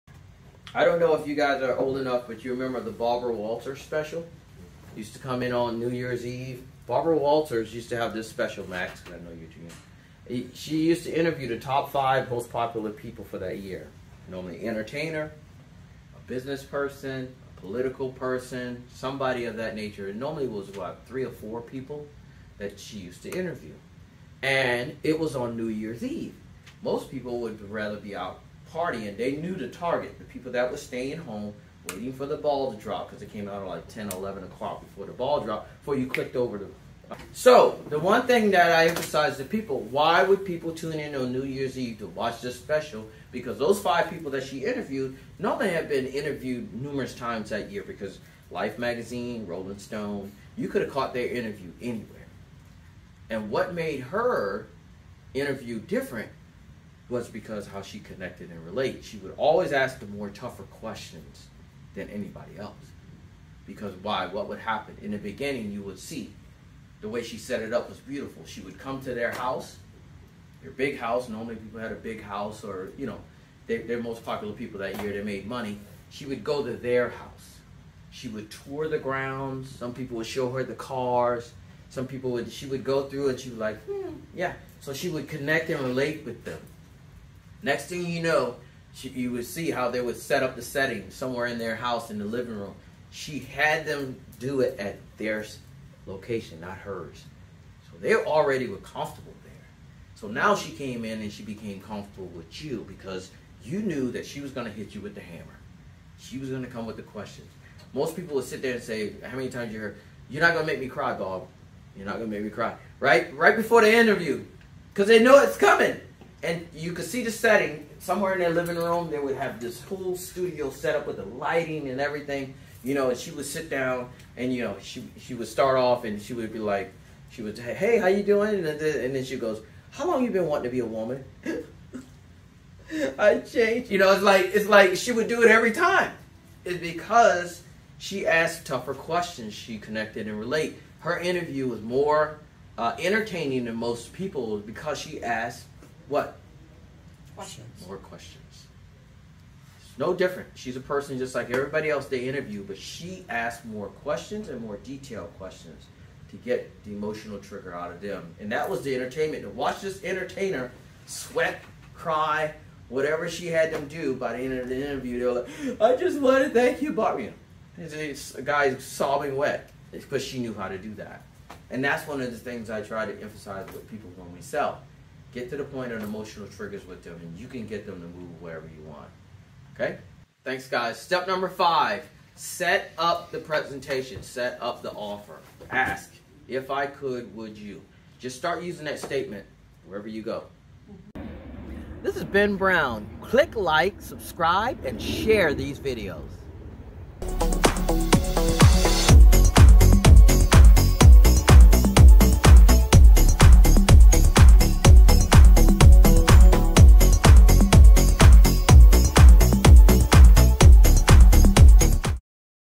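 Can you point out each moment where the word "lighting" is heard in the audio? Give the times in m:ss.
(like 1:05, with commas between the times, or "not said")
2:01.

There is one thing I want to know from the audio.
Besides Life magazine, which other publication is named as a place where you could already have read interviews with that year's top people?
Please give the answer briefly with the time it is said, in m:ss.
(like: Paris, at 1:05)
Rolling Stone, at 0:49.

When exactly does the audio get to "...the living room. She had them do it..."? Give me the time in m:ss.
1:32.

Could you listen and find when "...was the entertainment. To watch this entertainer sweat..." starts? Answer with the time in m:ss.
2:38.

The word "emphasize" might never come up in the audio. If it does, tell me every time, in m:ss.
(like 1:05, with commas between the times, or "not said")
0:38, 2:53.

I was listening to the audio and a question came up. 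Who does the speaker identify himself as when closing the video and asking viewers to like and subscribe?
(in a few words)
Ben Brown.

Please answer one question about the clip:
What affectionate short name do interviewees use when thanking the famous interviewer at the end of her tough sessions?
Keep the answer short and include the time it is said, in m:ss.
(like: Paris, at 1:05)
Barbie, at 2:46.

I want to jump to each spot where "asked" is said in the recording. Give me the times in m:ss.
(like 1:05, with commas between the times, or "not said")
2:18, 2:25, 2:33.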